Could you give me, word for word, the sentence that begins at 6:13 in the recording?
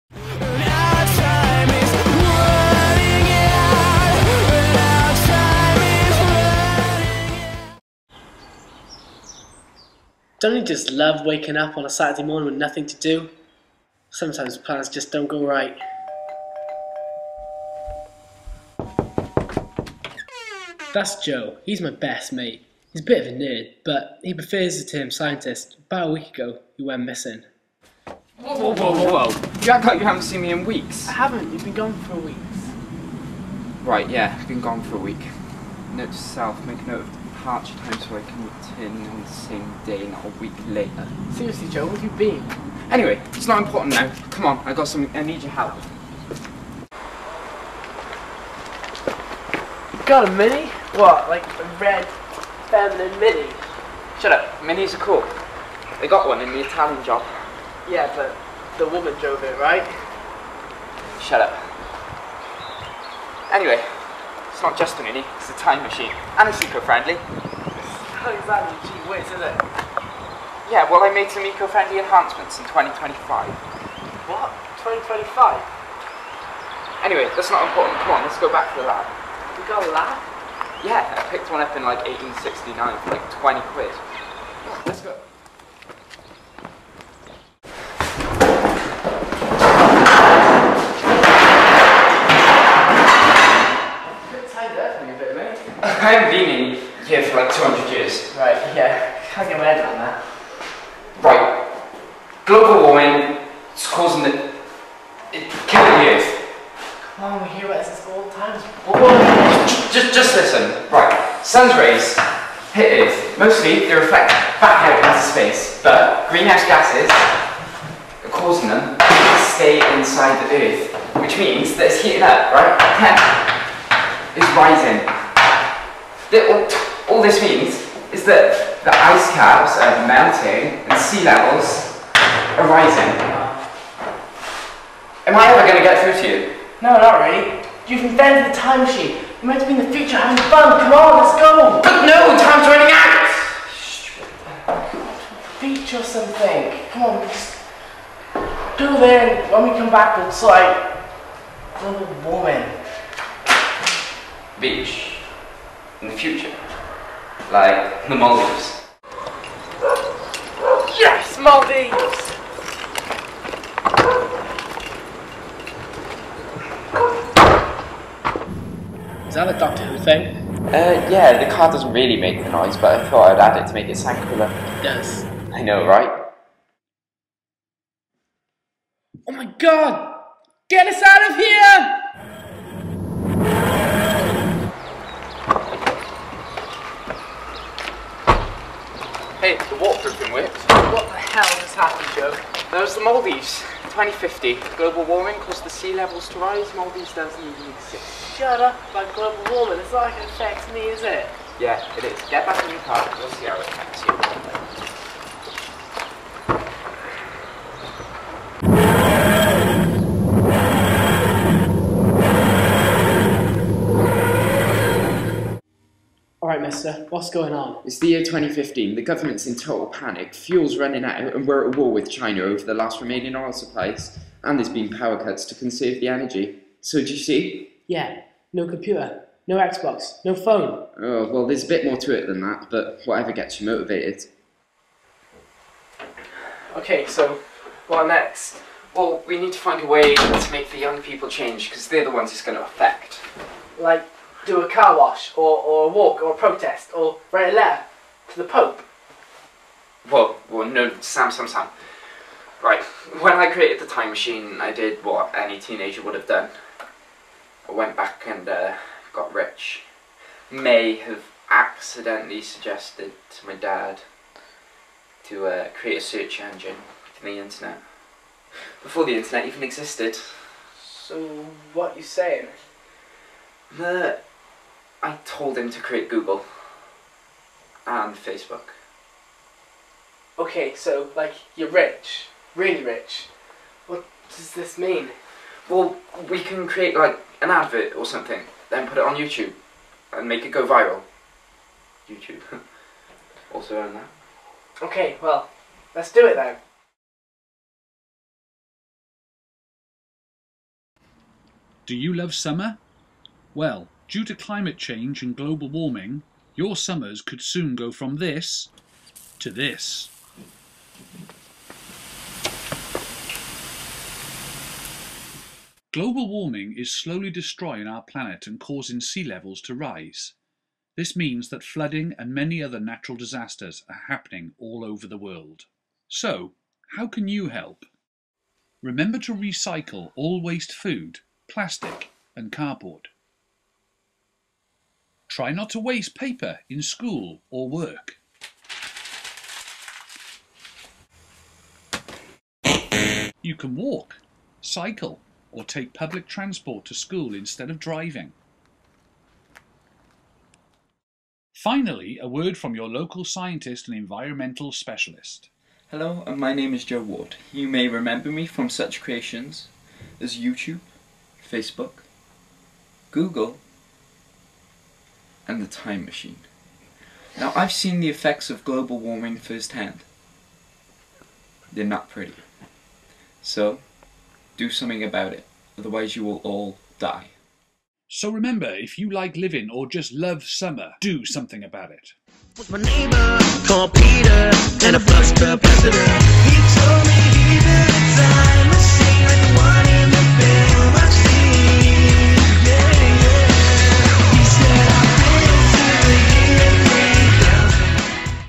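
So, do something about it, otherwise you will all die.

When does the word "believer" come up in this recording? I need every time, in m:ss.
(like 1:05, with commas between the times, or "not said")
not said.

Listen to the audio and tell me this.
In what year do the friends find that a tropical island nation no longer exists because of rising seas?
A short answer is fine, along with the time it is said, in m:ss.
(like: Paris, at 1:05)
2050, at 3:13.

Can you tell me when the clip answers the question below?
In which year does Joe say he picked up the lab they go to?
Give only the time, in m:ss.
1:22.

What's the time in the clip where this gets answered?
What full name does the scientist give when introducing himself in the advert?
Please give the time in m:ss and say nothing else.
5:56.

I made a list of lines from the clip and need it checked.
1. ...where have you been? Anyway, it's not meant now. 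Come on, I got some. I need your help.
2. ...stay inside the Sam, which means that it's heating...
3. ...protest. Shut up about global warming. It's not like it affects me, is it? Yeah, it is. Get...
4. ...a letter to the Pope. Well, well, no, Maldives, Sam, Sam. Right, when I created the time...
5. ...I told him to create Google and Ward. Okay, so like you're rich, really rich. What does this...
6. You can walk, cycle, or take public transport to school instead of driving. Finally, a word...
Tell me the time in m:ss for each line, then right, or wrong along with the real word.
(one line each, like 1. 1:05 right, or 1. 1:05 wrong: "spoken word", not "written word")
1. 0:41 wrong: "important", not "meant"
2. 1:59 wrong: "Earth", not "Sam"
3. 3:17 wrong: "exist", not "protest"
4. 4:07 wrong: "Sam", not "Maldives"
5. 4:35 wrong: "Facebook", not "Ward"
6. 5:43 right.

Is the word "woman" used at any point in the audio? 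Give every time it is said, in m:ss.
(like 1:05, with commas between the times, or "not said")
0:58, 2:32.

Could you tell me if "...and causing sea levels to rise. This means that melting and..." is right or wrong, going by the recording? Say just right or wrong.
wrong.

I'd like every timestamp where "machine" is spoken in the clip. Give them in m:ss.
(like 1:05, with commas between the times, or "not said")
1:05, 2:18, 4:14, 6:06.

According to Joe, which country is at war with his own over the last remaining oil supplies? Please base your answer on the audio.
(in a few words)
China.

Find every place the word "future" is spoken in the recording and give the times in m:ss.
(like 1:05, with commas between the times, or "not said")
2:19, 2:36.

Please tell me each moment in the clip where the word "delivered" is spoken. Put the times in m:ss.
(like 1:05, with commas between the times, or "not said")
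not said.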